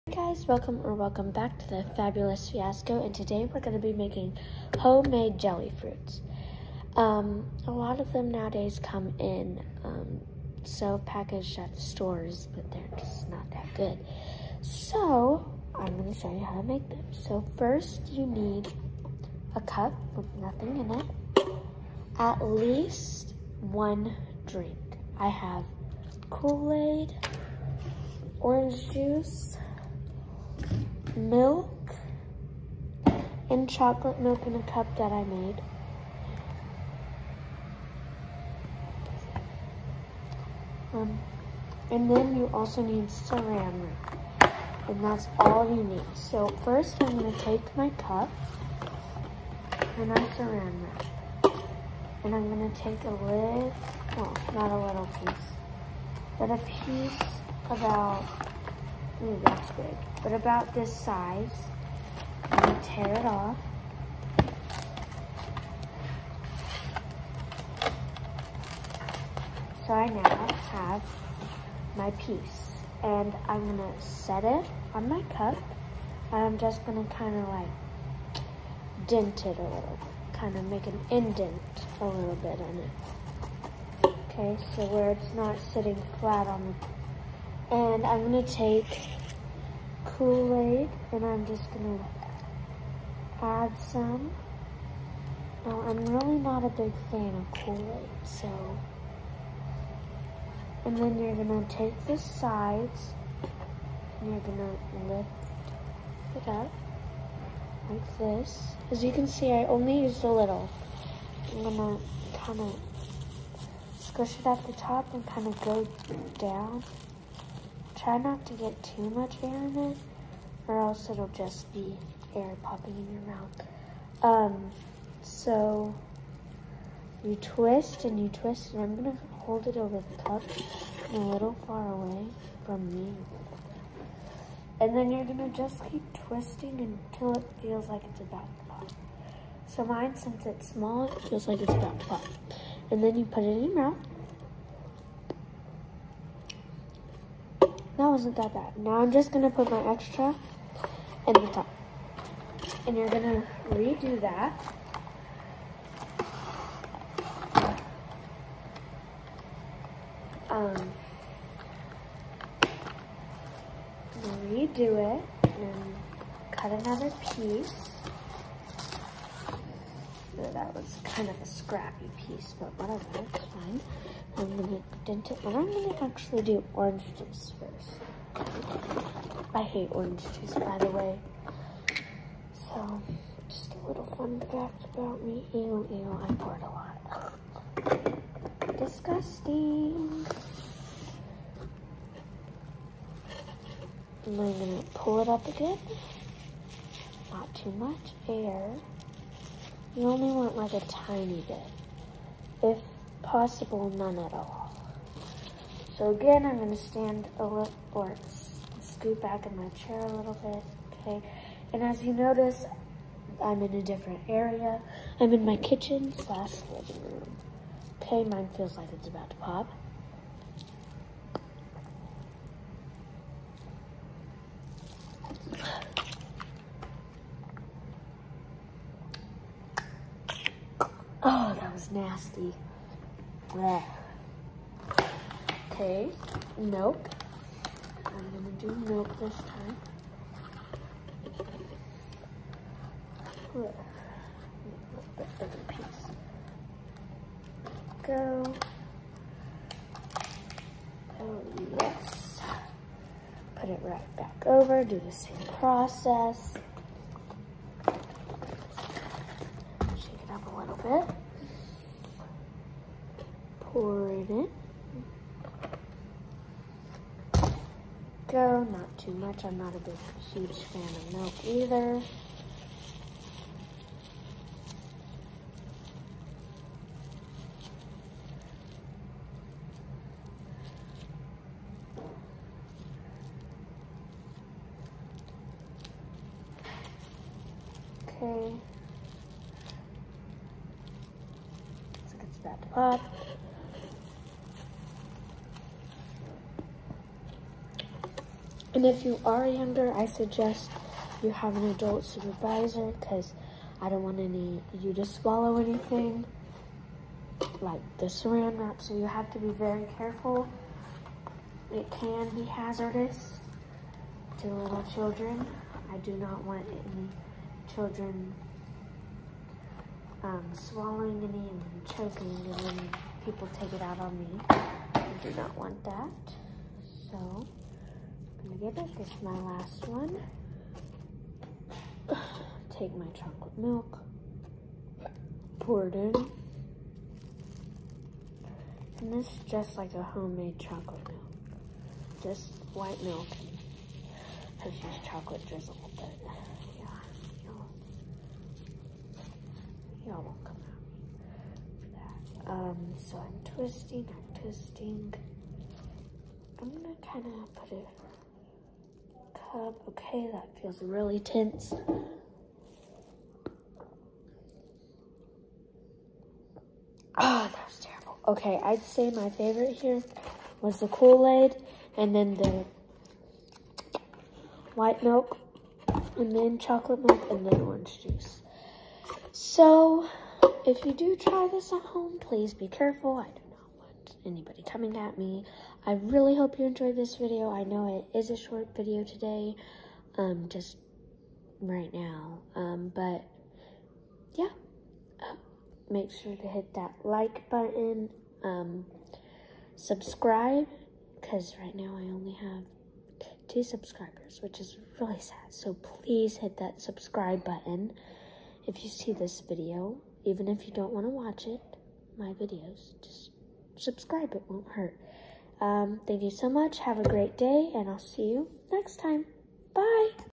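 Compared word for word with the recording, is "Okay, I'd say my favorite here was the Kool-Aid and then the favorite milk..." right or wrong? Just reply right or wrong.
wrong.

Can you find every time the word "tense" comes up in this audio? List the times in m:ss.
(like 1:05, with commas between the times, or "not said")
6:01.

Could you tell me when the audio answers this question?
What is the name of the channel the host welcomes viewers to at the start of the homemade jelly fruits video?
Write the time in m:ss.
0:01.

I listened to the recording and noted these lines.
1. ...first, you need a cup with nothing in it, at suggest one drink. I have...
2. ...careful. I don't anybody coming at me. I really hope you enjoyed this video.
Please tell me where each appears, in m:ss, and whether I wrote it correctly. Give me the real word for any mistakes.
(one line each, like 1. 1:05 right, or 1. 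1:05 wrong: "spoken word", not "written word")
1. 0:17 wrong: "least", not "suggest"
2. 6:22 right.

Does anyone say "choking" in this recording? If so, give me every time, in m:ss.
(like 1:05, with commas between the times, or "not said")
5:21.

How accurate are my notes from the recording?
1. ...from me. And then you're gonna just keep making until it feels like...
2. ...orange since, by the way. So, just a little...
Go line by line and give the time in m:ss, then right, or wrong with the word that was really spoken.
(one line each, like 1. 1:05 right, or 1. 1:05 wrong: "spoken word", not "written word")
1. 2:12 wrong: "twisting", not "making"
2. 2:59 wrong: "juice", not "since".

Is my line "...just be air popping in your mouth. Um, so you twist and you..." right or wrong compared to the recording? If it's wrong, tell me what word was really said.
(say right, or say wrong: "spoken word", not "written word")
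right.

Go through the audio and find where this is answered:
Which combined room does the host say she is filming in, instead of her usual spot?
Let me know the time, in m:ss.
3:35.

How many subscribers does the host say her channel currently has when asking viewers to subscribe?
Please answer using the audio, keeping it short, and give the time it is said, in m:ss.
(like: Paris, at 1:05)
2, at 6:43.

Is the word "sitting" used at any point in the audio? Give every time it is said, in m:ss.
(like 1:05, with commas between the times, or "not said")
1:25.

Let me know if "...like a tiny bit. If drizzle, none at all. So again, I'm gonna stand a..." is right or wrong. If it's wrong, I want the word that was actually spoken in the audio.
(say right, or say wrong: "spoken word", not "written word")
wrong: "possible", not "drizzle".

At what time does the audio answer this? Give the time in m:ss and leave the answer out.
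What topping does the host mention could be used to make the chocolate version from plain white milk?
5:45.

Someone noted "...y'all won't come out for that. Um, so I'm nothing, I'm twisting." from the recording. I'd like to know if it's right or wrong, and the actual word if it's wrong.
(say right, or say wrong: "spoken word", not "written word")
wrong: "twisting", not "nothing".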